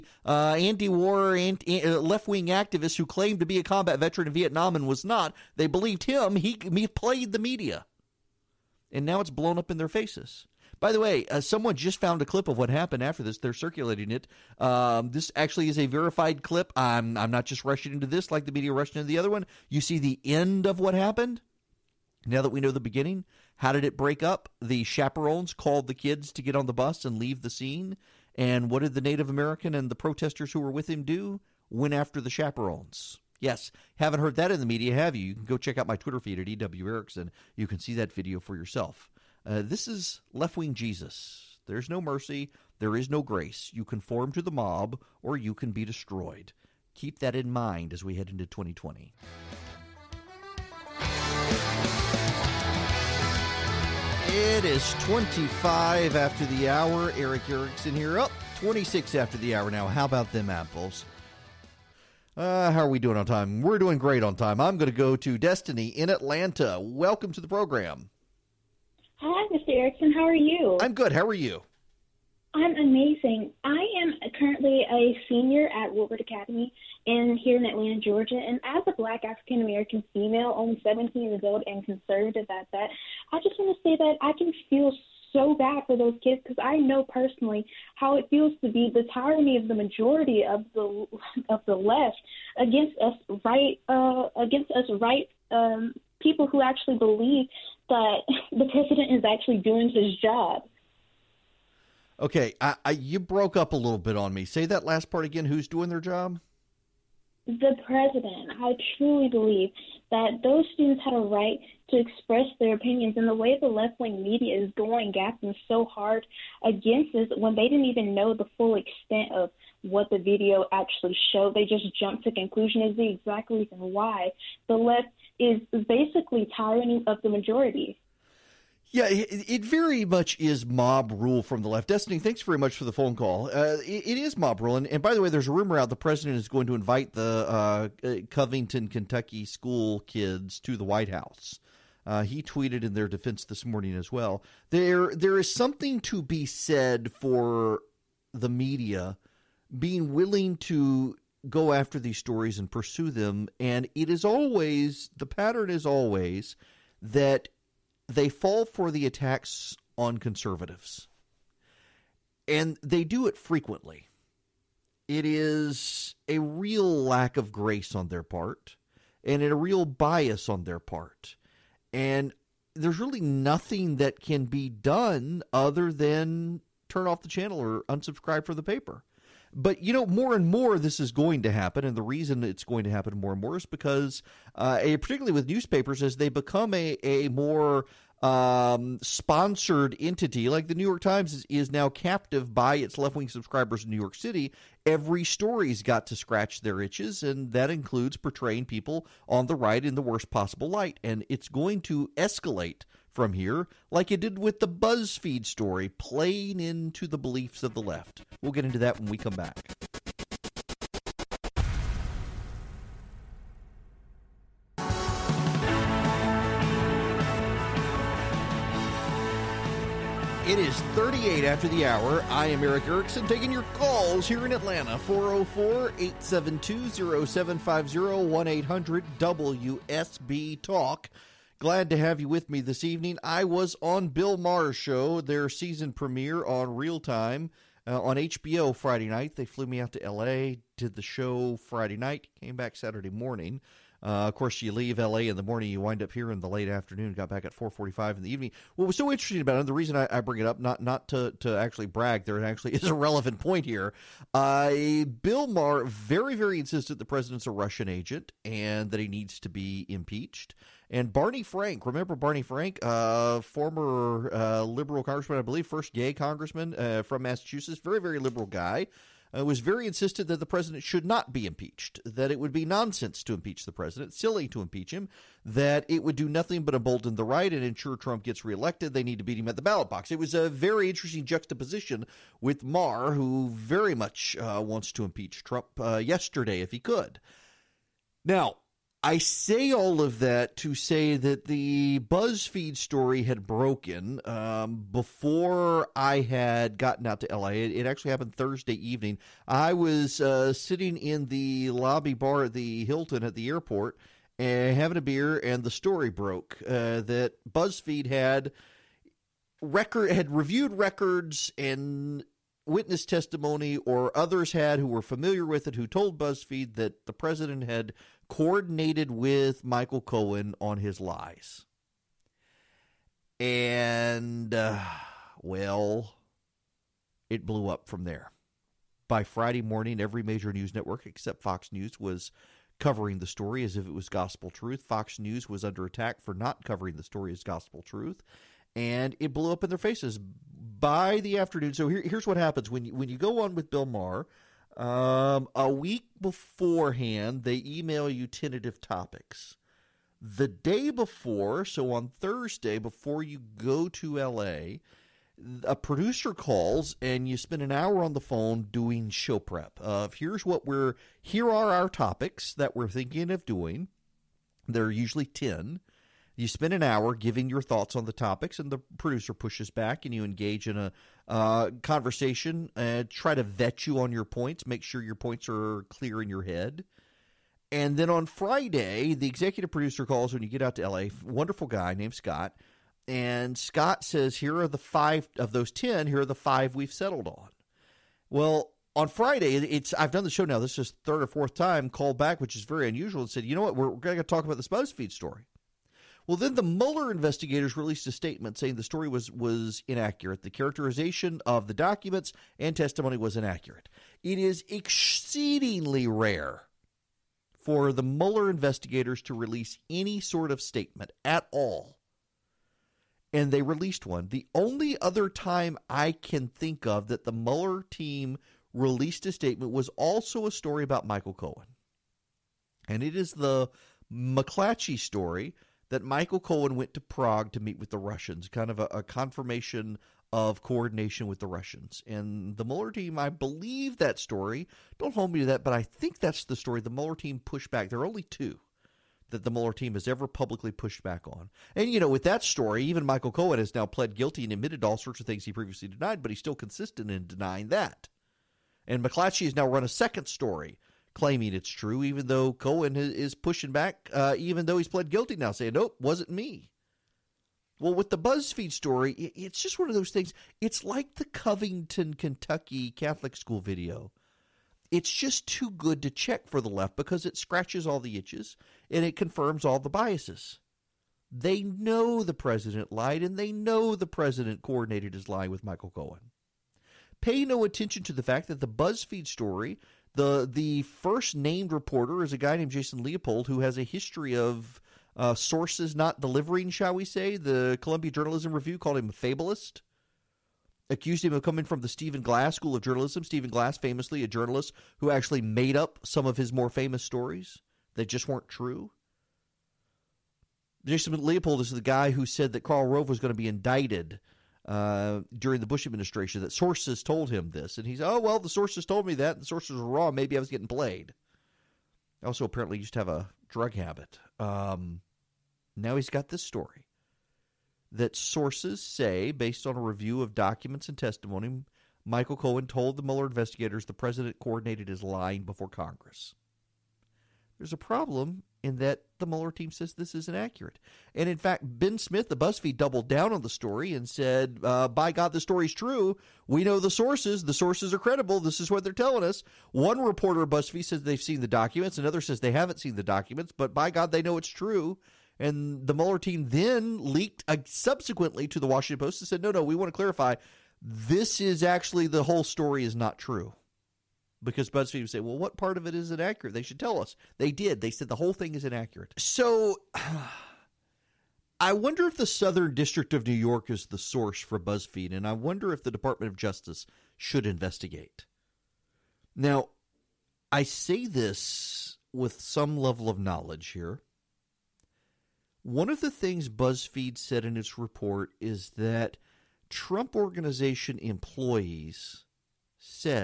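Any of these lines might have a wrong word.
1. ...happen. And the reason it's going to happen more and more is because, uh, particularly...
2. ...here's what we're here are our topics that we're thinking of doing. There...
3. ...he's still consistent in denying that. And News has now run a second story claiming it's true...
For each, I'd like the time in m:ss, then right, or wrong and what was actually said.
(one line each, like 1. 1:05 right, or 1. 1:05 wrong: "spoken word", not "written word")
1. 3:01 right
2. 6:00 right
3. 7:26 wrong: "McClatchy", not "News".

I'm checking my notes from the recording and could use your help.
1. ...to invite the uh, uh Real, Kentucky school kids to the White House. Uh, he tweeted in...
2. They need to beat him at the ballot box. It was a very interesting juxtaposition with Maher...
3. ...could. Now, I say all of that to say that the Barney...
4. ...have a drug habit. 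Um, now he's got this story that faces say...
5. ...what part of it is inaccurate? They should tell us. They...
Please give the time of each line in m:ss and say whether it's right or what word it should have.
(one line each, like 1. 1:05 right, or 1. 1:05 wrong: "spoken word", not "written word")
1. 2:16 wrong: "Covington", not "Real"
2. 4:38 right
3. 4:46 wrong: "BuzzFeed", not "Barney"
4. 8:32 wrong: "sources", not "faces"
5. 9:15 right.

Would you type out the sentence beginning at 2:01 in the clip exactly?
They just jumped to conclusion is the exact reason why the left is basically tyranny of the majority.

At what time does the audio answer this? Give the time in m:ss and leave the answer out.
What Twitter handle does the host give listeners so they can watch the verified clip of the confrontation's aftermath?
0:36.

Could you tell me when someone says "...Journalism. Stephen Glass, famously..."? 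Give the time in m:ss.
8:12.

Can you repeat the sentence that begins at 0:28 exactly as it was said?
And what did the Native American and the protesters who were with him do?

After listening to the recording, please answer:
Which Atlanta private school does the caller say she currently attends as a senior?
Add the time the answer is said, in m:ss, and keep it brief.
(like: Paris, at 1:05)
Woodward Academy, at 1:15.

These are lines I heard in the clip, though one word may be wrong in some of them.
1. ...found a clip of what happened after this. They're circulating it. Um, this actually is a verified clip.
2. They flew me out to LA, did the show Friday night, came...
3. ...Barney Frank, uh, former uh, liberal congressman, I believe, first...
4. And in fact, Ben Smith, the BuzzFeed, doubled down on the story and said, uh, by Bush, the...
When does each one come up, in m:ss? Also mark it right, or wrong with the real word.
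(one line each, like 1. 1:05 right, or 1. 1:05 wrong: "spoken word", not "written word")
1. 0:11 right
2. 3:59 right
3. 4:22 right
4. 8:51 wrong: "God", not "Bush".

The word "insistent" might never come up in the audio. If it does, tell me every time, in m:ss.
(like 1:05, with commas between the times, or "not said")
4:16, 4:29.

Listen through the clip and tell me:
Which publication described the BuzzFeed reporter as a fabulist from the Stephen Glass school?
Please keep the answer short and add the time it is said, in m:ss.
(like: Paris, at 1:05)
Columbia Journalism Review, at 8:07.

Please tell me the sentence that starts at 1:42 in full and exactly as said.
Okay, I, I, you broke up a little bit on me.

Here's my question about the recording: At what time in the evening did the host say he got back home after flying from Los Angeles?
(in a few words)
4:45.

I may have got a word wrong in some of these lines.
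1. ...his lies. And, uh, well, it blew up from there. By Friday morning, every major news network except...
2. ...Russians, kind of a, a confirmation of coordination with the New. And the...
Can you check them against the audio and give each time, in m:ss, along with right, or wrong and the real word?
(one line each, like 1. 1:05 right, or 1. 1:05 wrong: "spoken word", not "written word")
1. 5:20 right
2. 7:07 wrong: "Russians", not "New".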